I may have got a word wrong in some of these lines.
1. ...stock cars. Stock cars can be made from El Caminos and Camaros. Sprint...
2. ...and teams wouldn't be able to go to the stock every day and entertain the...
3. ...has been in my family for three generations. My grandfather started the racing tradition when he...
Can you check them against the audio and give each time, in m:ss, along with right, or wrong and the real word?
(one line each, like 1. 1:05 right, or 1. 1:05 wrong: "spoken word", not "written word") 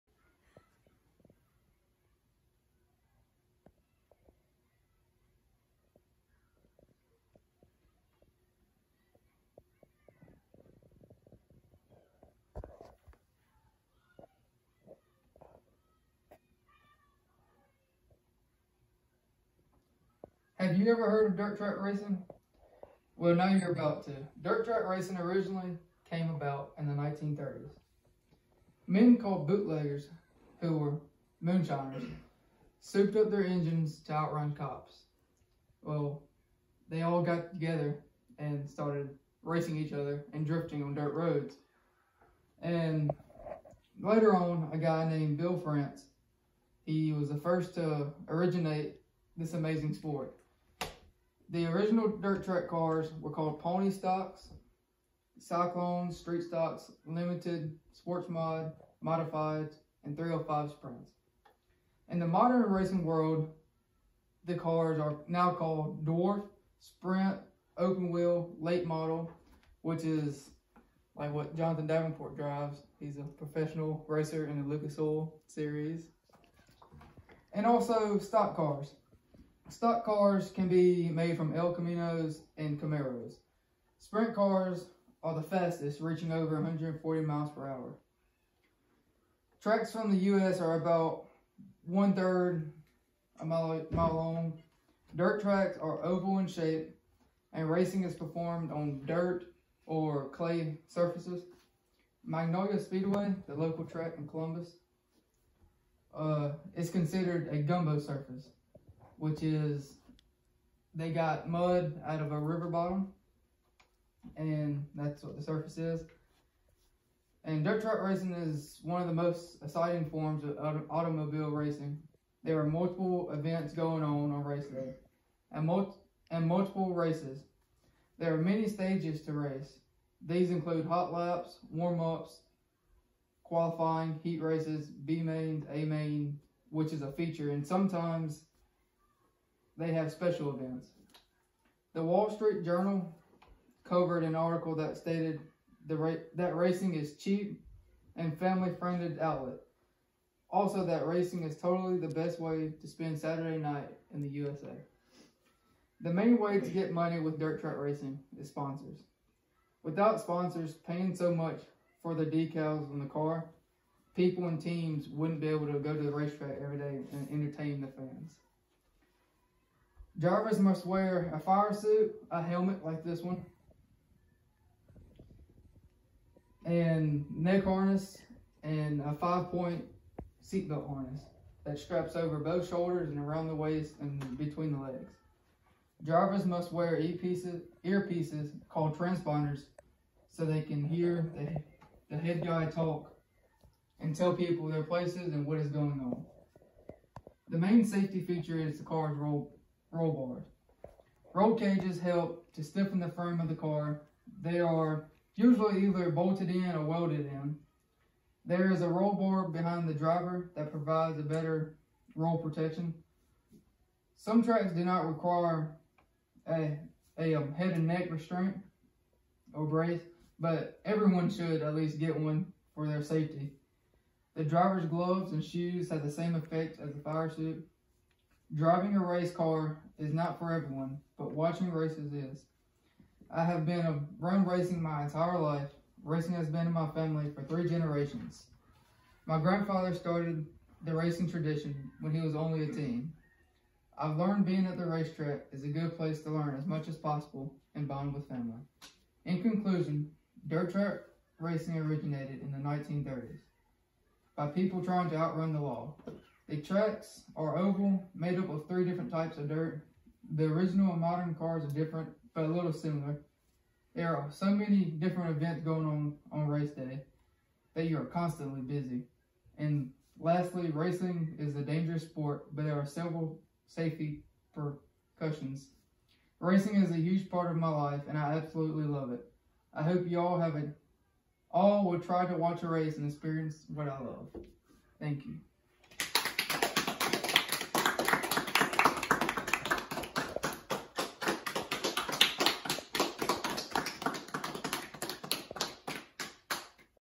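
1. 1:18 right
2. 2:44 wrong: "racetrack", not "stock"
3. 3:56 right.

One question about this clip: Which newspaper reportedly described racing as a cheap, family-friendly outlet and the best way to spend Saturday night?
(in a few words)
The Wall Street Journal.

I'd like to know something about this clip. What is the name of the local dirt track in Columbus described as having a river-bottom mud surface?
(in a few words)
Magnolia Speedway.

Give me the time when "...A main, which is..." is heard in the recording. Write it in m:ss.
2:15.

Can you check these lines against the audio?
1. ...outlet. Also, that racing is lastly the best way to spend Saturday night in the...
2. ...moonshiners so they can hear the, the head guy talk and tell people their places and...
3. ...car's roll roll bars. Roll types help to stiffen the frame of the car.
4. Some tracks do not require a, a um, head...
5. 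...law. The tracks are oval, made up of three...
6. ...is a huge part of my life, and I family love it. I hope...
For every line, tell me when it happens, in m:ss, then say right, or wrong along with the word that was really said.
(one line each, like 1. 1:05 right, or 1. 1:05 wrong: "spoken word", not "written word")
1. 2:29 wrong: "totally", not "lastly"
2. 3:08 wrong: "transponders", not "moonshiners"
3. 3:18 wrong: "cages", not "types"
4. 3:34 right
5. 4:15 right
6. 4:36 wrong: "absolutely", not "family".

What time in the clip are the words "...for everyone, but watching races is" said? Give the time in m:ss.
3:50.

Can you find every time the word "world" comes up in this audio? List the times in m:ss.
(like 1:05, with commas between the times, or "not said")
1:03.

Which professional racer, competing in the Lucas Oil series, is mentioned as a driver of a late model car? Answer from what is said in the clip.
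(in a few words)
Jonathan Davenport.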